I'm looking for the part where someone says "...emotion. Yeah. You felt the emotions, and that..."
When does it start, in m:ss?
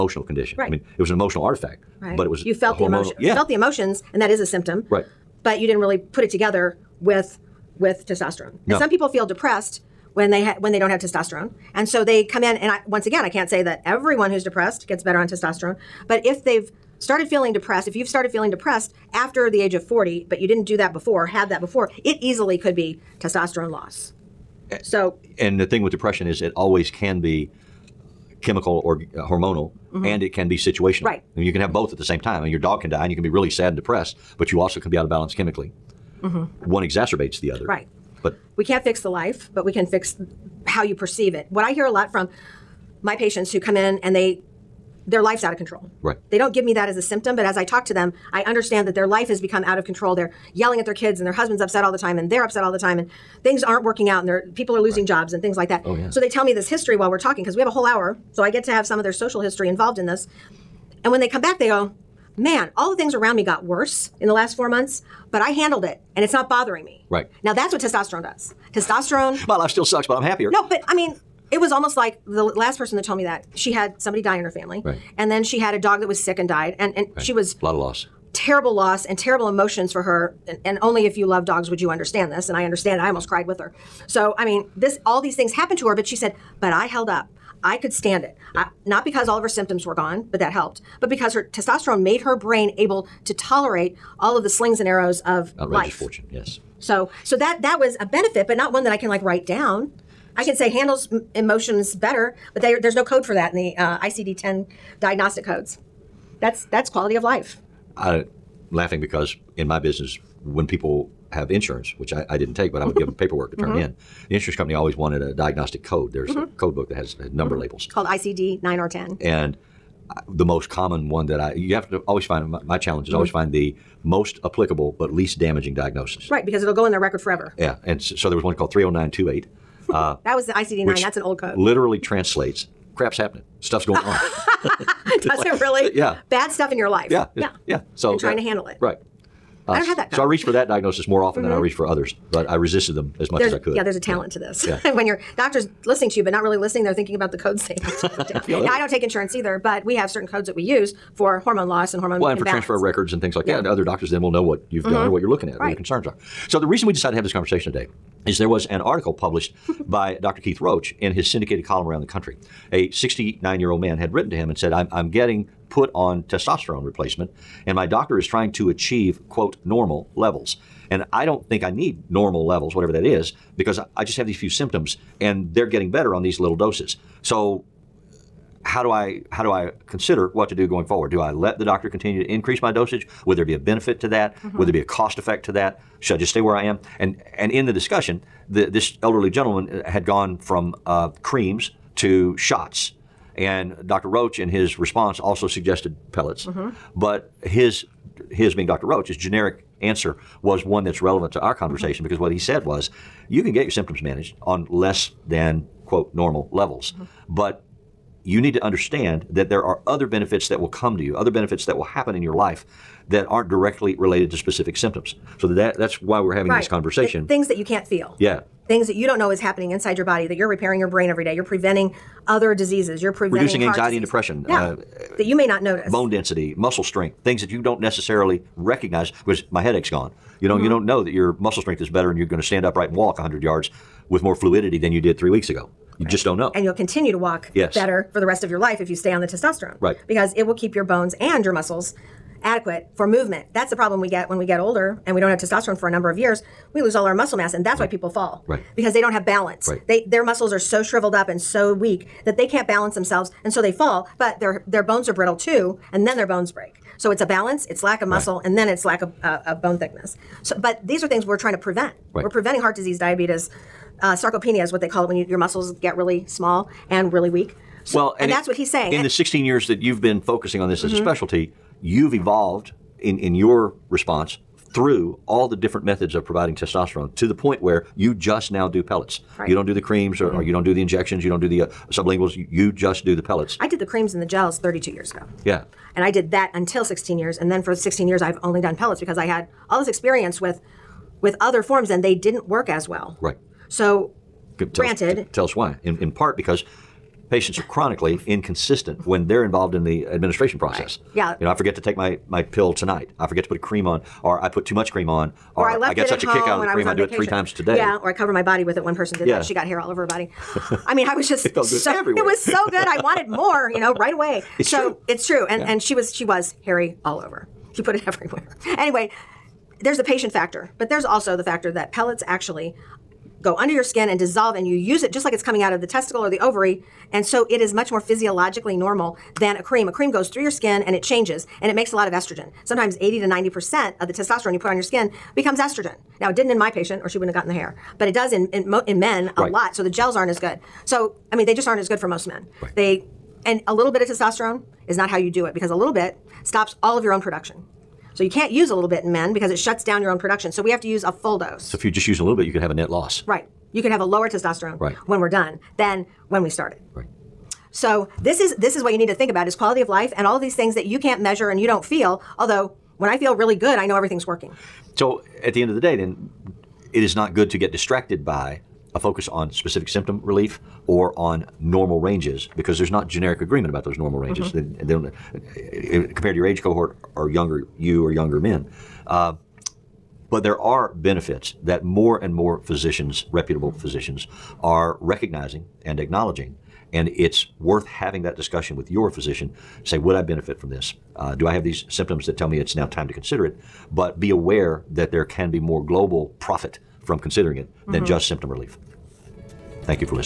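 0:02.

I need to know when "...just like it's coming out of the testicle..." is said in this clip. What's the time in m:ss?
5:25.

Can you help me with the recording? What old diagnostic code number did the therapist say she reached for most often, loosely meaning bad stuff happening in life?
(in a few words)
30928.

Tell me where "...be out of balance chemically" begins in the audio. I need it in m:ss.
0:34.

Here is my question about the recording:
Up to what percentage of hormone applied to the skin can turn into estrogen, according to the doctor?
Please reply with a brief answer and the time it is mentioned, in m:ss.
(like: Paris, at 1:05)
80 to 90%, at 5:32.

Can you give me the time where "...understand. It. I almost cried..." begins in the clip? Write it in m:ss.
1:22.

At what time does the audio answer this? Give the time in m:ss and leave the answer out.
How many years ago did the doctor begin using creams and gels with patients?
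4:44.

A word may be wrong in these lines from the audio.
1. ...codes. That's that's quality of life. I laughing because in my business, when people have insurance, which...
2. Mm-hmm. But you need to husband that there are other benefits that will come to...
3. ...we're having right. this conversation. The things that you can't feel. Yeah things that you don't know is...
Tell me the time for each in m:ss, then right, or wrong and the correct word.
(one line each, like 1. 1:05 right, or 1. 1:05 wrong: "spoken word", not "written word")
1. 1:45 right
2. 3:26 wrong: "understand", not "husband"
3. 3:36 right.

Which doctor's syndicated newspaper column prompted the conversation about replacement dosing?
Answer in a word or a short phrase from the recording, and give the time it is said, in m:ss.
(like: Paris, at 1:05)
Dr. Keith Roach, at 2:40.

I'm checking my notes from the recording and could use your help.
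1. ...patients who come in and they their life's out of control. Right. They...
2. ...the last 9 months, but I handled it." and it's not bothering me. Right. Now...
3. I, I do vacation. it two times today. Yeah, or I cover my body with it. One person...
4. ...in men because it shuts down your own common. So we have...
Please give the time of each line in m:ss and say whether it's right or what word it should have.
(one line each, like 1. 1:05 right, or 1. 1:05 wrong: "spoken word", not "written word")
1. 0:43 right
2. 1:04 wrong: "4", not "9"
3. 5:06 wrong: "three", not "two"
4. 5:49 wrong: "production", not "common".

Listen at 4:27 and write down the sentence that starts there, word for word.
So, well, and, and it, that's what he's saying.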